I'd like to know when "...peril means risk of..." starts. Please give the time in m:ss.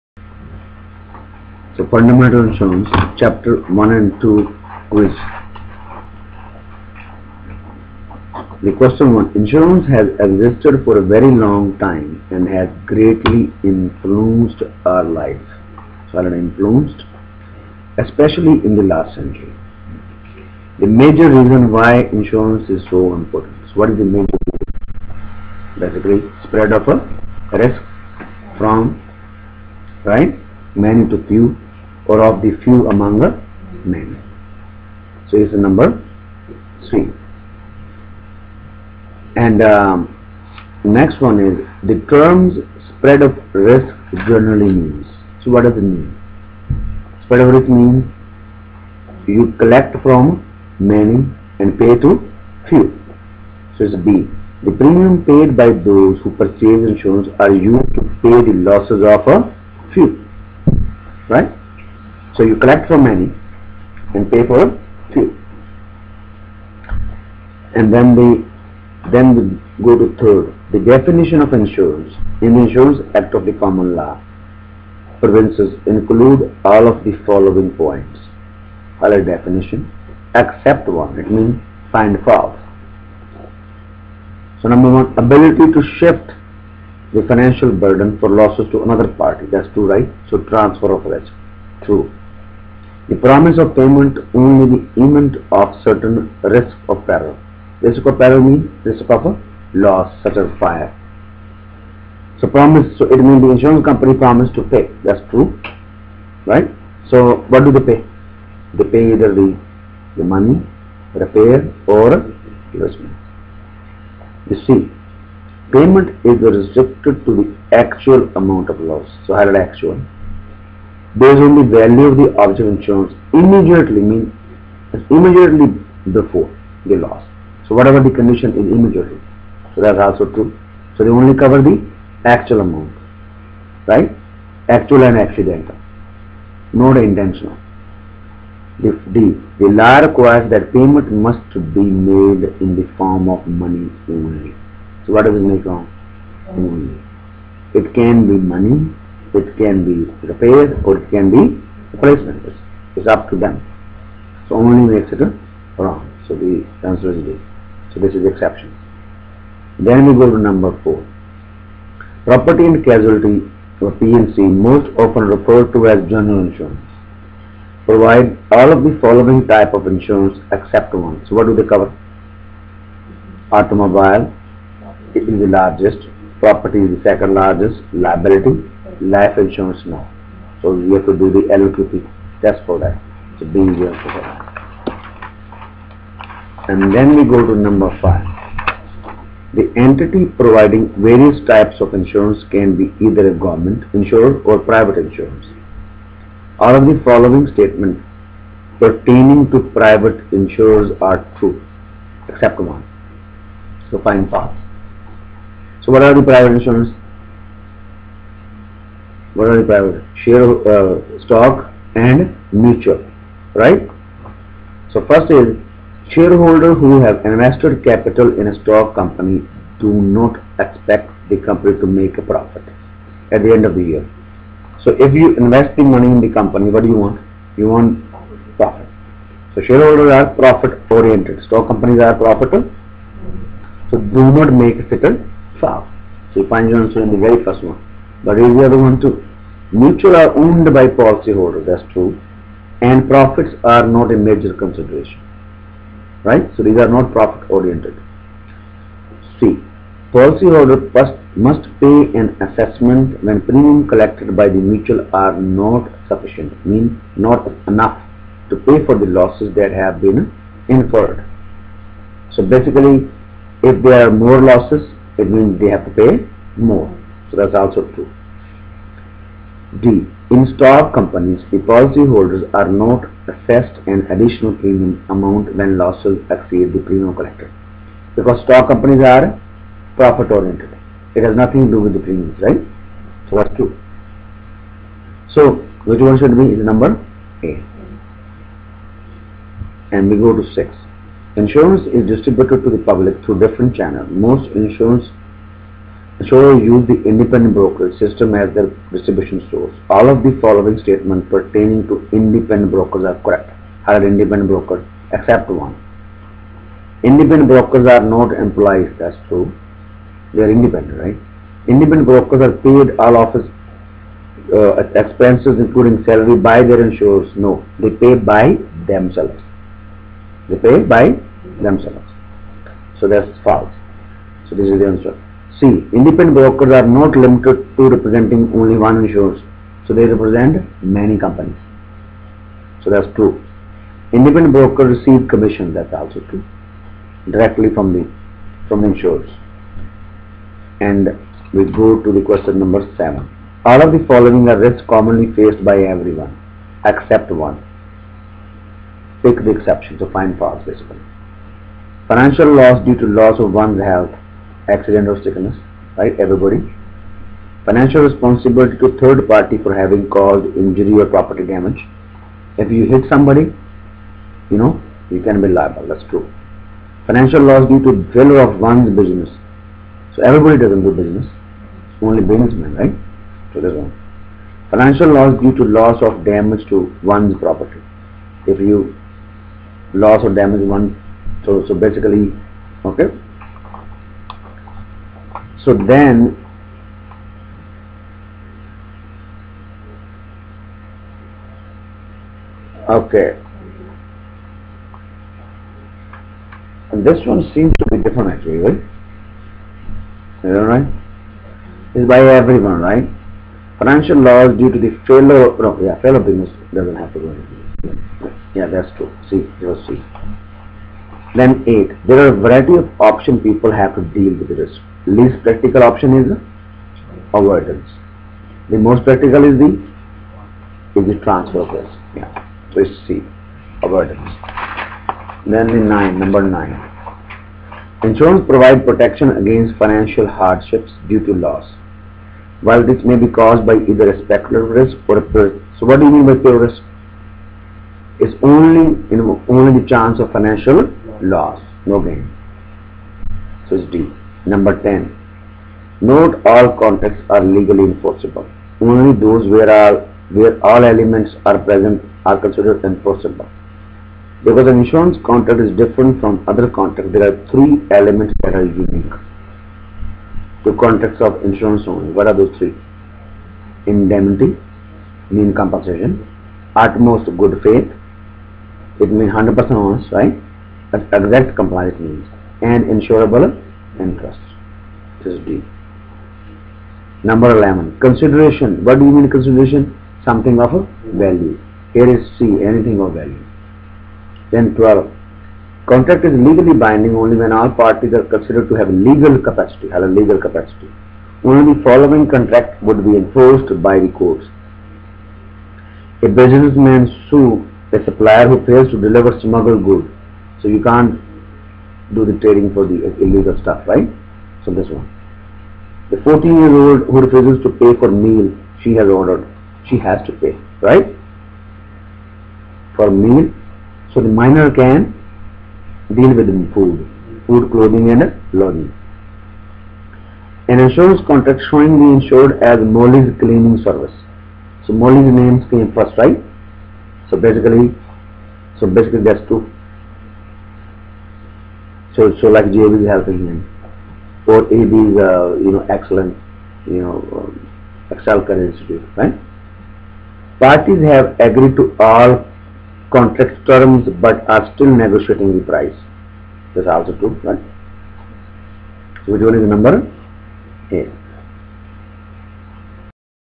1:38.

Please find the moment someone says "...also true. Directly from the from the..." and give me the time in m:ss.
5:35.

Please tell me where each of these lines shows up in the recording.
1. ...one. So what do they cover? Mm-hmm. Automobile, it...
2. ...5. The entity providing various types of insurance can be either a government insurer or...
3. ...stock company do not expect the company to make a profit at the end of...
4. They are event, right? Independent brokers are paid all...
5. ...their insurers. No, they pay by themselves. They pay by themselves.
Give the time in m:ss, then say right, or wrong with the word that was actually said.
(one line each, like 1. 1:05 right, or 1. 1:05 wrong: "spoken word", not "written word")
1. 2:50 right
2. 3:08 right
3. 3:38 right
4. 5:10 wrong: "independent", not "event"
5. 5:16 right.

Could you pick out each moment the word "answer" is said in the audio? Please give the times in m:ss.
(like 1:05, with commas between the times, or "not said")
2:36, 3:56, 5:24.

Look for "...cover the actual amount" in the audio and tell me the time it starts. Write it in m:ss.
2:11.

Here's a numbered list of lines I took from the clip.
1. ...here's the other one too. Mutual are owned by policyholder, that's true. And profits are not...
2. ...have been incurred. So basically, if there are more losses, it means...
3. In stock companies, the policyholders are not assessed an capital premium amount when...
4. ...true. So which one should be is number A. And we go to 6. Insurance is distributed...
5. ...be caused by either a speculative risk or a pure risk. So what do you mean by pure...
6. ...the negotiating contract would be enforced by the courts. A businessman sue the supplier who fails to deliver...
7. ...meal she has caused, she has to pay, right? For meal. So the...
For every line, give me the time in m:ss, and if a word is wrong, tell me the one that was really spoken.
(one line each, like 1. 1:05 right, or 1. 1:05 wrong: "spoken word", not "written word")
1. 3:58 right
2. 4:19 right
3. 4:30 wrong: "additional", not "capital"
4. 4:43 right
5. 7:13 right
6. 8:11 wrong: "following", not "negotiating"
7. 8:28 wrong: "ordered", not "caused".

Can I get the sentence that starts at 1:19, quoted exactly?
Other definition, except one, it means find false.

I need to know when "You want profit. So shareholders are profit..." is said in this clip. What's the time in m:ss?
3:47.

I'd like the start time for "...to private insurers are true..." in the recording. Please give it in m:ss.
3:19.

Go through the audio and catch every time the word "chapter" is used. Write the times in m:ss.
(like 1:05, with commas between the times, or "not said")
0:03.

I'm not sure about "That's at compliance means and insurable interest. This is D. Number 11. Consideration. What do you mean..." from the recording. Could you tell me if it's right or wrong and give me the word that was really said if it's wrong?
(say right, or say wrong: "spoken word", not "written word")
right.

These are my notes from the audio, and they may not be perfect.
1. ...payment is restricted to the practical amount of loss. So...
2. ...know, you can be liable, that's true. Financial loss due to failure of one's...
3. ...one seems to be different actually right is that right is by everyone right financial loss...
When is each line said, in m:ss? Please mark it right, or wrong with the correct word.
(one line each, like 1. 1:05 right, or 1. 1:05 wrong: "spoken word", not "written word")
1. 1:55 wrong: "actual", not "practical"
2. 6:04 right
3. 6:37 right.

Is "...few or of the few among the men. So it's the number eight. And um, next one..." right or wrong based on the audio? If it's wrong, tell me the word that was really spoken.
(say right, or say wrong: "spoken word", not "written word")
wrong: "three", not "eight".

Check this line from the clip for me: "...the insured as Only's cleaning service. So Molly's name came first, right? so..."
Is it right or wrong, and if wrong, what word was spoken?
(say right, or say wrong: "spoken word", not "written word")
wrong: "Molly", not "Only".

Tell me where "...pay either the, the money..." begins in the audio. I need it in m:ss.
1:48.